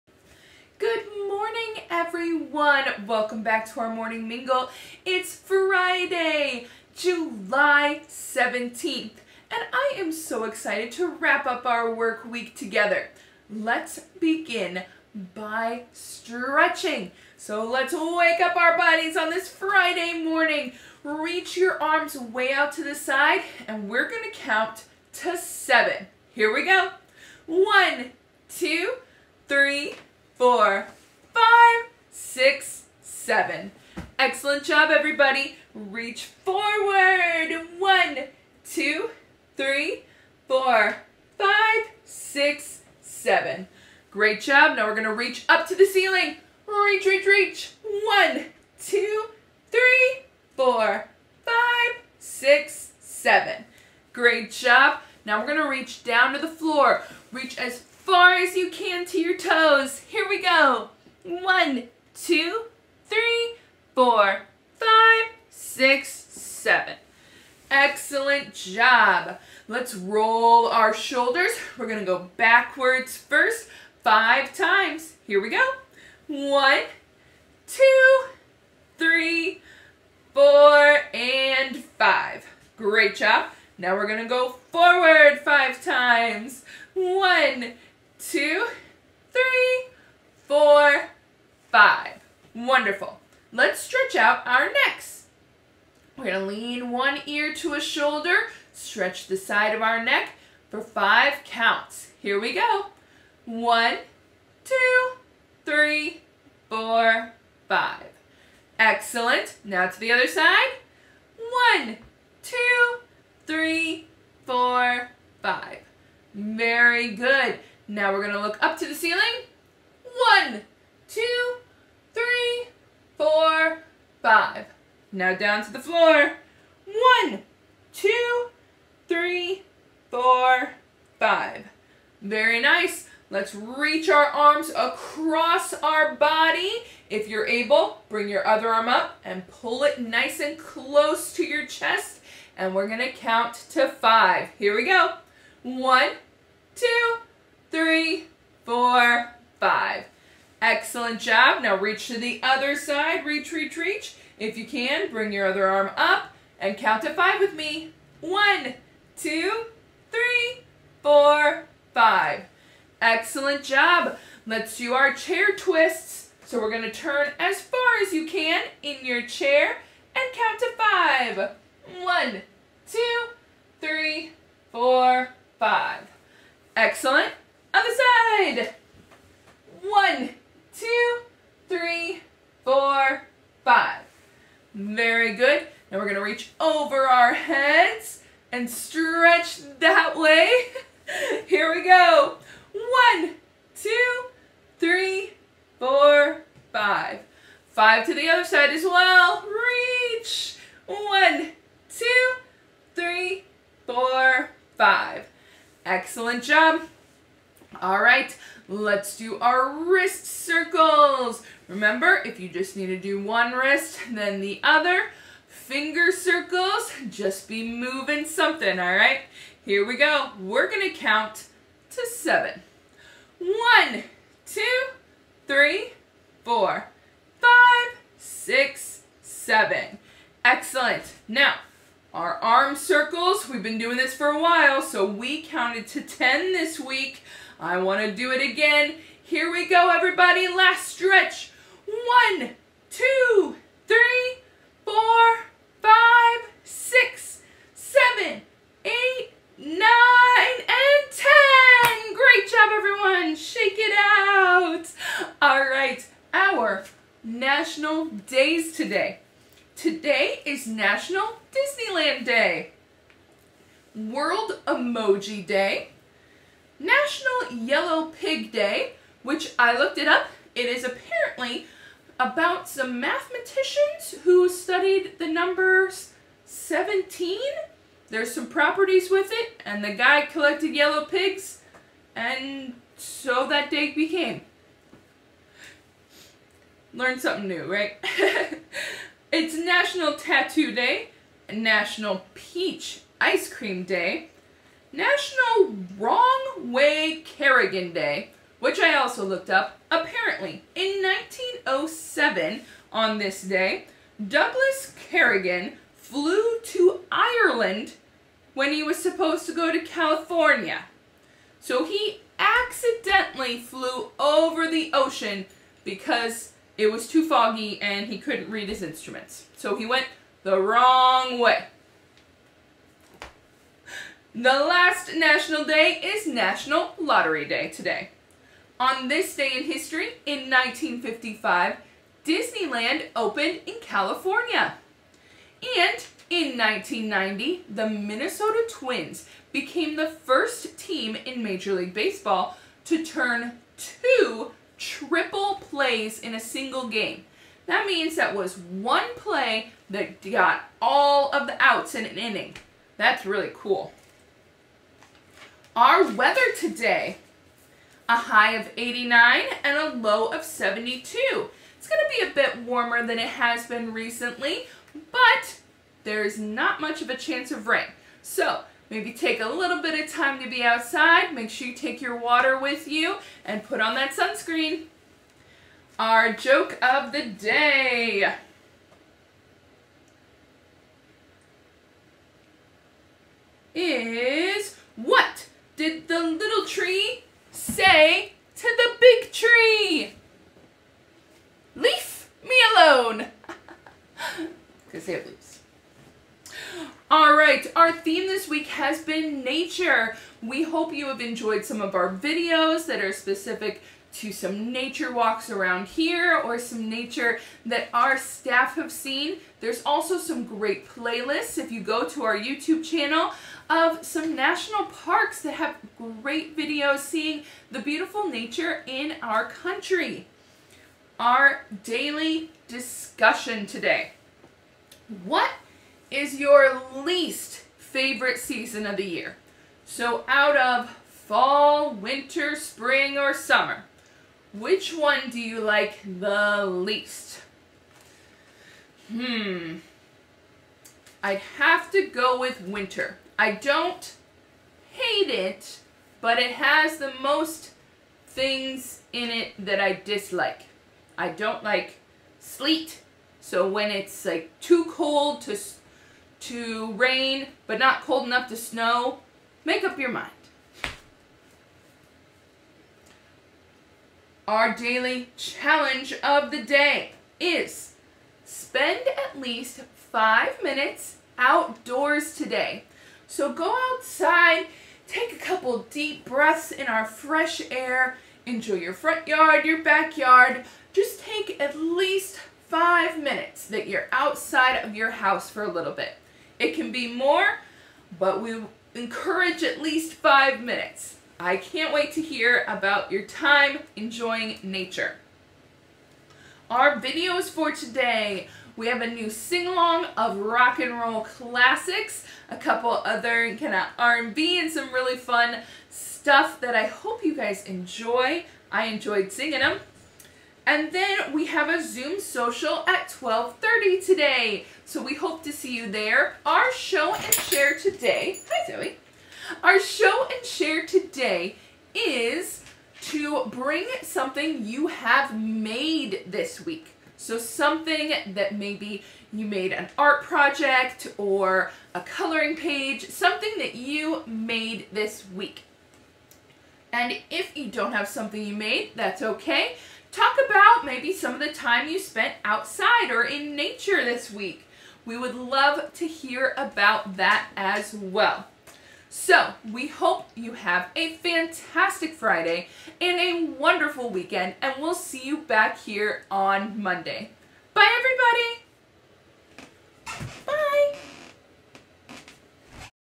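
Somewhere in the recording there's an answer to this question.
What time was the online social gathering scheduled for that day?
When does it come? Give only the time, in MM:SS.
08:33.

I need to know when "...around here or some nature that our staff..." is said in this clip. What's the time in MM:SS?
06:45.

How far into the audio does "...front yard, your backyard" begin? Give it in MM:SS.
07:58.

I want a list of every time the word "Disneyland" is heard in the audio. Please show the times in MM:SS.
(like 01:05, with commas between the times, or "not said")
04:21, 05:32.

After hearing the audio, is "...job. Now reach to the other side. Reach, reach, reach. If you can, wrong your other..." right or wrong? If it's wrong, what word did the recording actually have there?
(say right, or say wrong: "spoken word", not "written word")
wrong: "bring", not "wrong".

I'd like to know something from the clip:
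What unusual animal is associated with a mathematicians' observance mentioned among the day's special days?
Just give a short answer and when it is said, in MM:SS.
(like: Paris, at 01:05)
Yellow pigs, at 04:40.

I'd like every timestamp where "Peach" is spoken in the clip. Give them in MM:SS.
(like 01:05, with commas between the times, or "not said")
04:52.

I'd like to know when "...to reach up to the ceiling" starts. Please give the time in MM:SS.
00:45.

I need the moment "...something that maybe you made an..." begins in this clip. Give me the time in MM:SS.
08:47.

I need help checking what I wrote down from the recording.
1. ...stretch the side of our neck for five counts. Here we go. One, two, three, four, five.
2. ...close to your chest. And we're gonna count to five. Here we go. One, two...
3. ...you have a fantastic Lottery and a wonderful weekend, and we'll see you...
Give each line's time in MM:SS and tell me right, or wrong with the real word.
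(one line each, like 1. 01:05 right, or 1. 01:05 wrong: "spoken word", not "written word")
1. 01:38 right
2. 02:20 right
3. 09:10 wrong: "Friday", not "Lottery".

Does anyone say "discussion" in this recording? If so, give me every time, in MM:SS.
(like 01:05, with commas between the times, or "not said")
07:02.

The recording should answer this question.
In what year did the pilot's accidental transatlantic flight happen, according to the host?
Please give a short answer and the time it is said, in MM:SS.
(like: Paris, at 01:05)
1907, at 05:01.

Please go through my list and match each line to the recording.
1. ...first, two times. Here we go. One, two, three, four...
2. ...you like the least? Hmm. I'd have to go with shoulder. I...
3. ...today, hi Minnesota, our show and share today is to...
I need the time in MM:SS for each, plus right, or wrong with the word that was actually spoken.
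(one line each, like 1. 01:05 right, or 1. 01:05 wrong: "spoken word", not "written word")
1. 01:13 wrong: "five", not "two"
2. 07:15 wrong: "winter", not "shoulder"
3. 08:37 wrong: "Zoe", not "Minnesota".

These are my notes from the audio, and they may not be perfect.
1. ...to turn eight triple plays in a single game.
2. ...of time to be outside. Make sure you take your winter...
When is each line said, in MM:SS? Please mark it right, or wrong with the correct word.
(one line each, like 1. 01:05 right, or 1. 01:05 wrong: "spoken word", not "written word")
1. 05:42 wrong: "two", not "eight"
2. 06:09 wrong: "water", not "winter".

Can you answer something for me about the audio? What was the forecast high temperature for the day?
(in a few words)
89.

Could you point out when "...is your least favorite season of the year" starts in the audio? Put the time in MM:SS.
07:06.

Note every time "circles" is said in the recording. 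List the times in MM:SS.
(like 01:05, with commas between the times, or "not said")
03:30, 03:36, 03:52.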